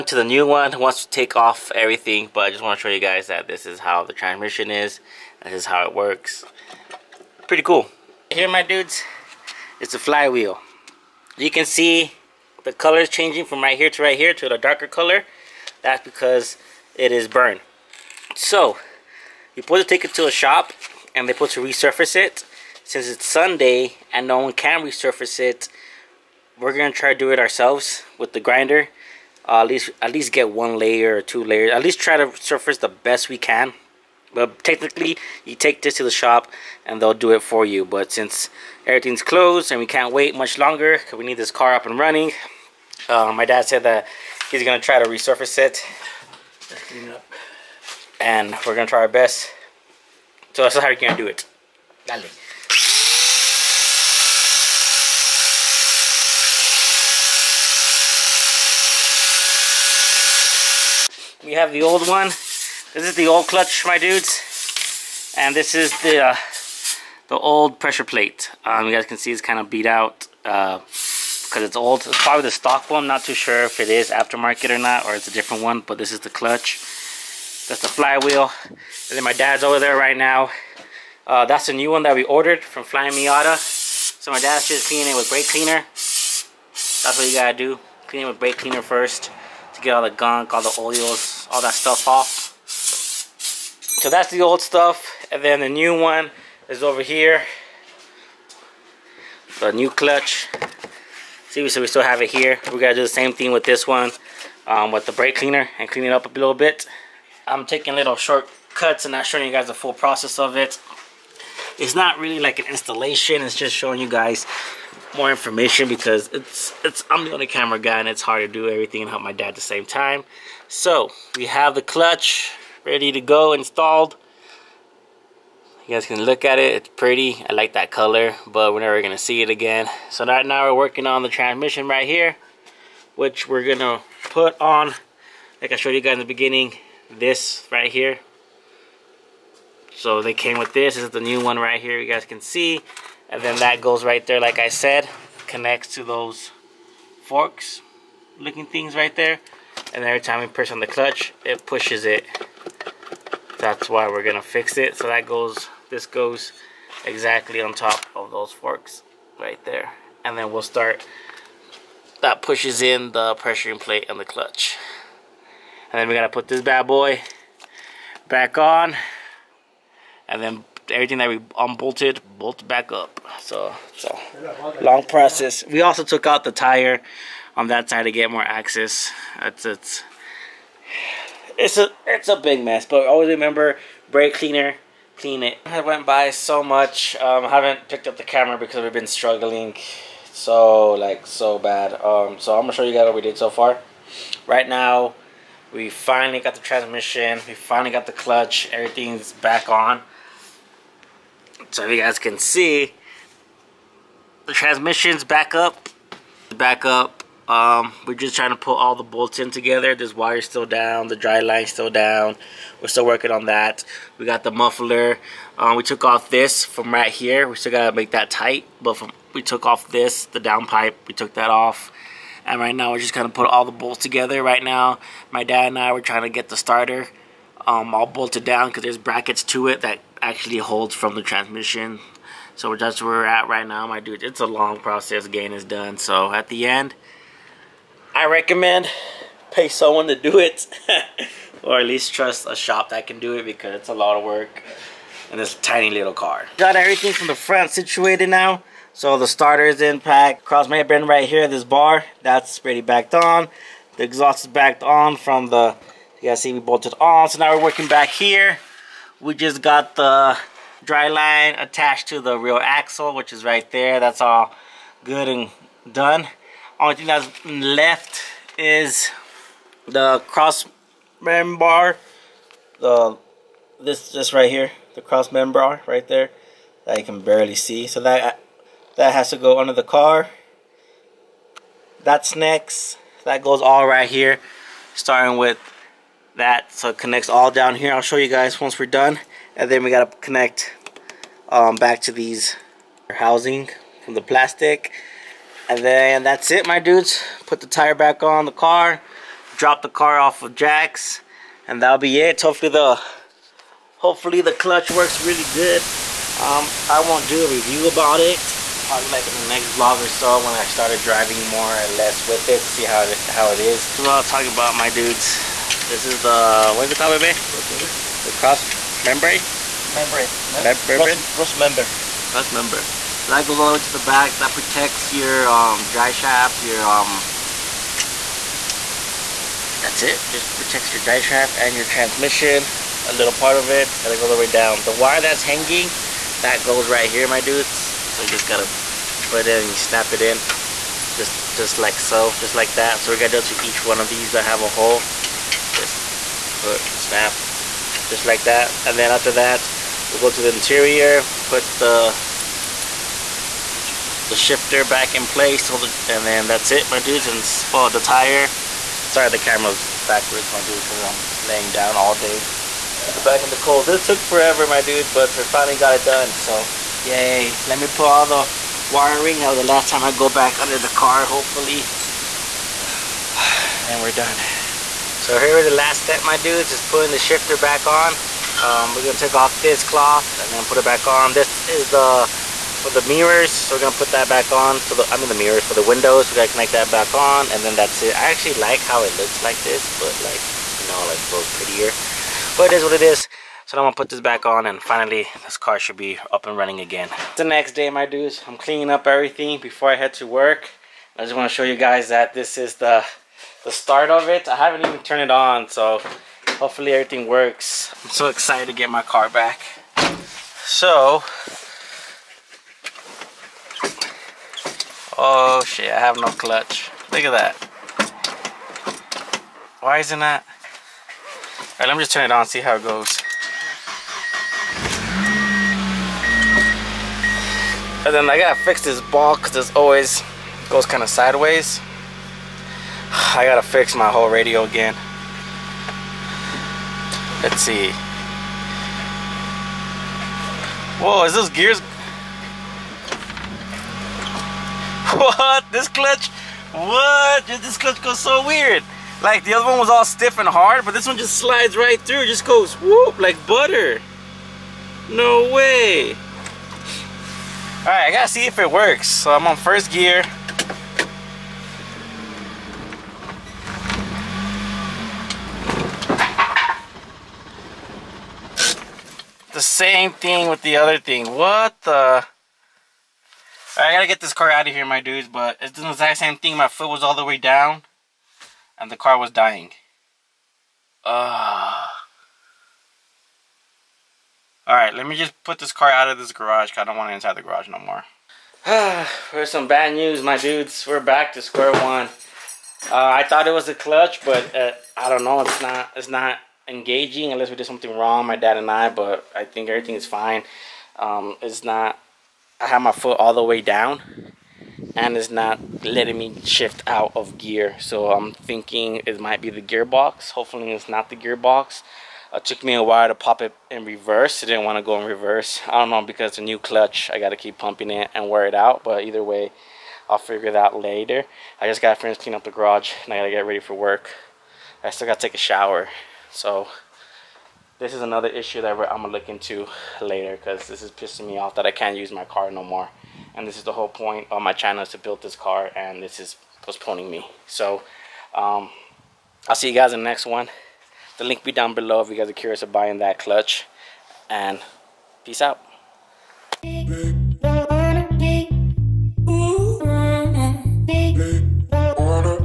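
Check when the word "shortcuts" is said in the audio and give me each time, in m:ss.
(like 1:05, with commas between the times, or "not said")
1:48.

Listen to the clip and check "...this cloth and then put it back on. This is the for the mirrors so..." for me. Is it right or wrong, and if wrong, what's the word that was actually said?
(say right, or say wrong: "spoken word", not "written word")
right.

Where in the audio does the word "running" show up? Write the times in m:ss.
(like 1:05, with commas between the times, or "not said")
0:41, 6:36.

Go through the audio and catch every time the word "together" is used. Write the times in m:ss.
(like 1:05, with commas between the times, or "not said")
3:29, 3:44.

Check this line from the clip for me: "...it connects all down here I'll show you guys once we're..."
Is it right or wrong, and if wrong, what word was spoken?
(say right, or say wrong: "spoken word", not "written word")
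right.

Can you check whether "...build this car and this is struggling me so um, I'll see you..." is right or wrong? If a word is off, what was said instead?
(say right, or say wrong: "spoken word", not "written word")
wrong: "postponing", not "struggling".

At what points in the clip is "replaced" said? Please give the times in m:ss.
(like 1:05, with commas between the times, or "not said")
not said.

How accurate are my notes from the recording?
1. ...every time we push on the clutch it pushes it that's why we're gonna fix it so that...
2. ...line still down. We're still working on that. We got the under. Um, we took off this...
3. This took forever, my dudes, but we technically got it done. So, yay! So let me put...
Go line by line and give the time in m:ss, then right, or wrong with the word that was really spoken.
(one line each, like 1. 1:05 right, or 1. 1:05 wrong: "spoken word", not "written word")
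1. 2:30 right
2. 3:31 wrong: "muffler", not "under"
3. 6:03 wrong: "finally", not "technically".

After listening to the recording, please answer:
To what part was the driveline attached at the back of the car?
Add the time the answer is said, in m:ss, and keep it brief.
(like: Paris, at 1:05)
rear axle, at 4:22.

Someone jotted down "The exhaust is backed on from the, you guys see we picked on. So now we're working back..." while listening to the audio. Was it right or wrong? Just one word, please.
wrong.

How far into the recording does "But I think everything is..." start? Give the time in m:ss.
8:18.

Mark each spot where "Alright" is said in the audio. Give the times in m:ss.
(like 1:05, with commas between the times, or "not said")
7:01, 8:04.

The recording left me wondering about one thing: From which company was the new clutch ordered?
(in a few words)
Flyin Miata.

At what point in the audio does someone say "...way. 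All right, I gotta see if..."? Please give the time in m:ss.
7:35.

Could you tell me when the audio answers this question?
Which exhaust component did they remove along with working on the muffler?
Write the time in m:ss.
3:40.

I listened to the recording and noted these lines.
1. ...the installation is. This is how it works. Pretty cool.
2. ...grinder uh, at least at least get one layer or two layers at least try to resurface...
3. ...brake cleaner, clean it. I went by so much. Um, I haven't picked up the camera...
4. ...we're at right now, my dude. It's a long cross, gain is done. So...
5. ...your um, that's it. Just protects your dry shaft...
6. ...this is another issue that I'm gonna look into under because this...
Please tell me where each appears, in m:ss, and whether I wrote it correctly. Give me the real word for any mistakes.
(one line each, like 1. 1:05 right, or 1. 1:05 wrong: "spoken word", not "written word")
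1. 0:04 wrong: "transmission", not "installation"
2. 0:28 wrong: "surface", not "resurface"
3. 3:04 right
4. 3:53 wrong: "process", not "cross"
5. 5:26 right
6. 8:47 wrong: "later", not "under".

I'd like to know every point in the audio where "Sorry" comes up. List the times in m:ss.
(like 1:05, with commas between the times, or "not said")
5:59.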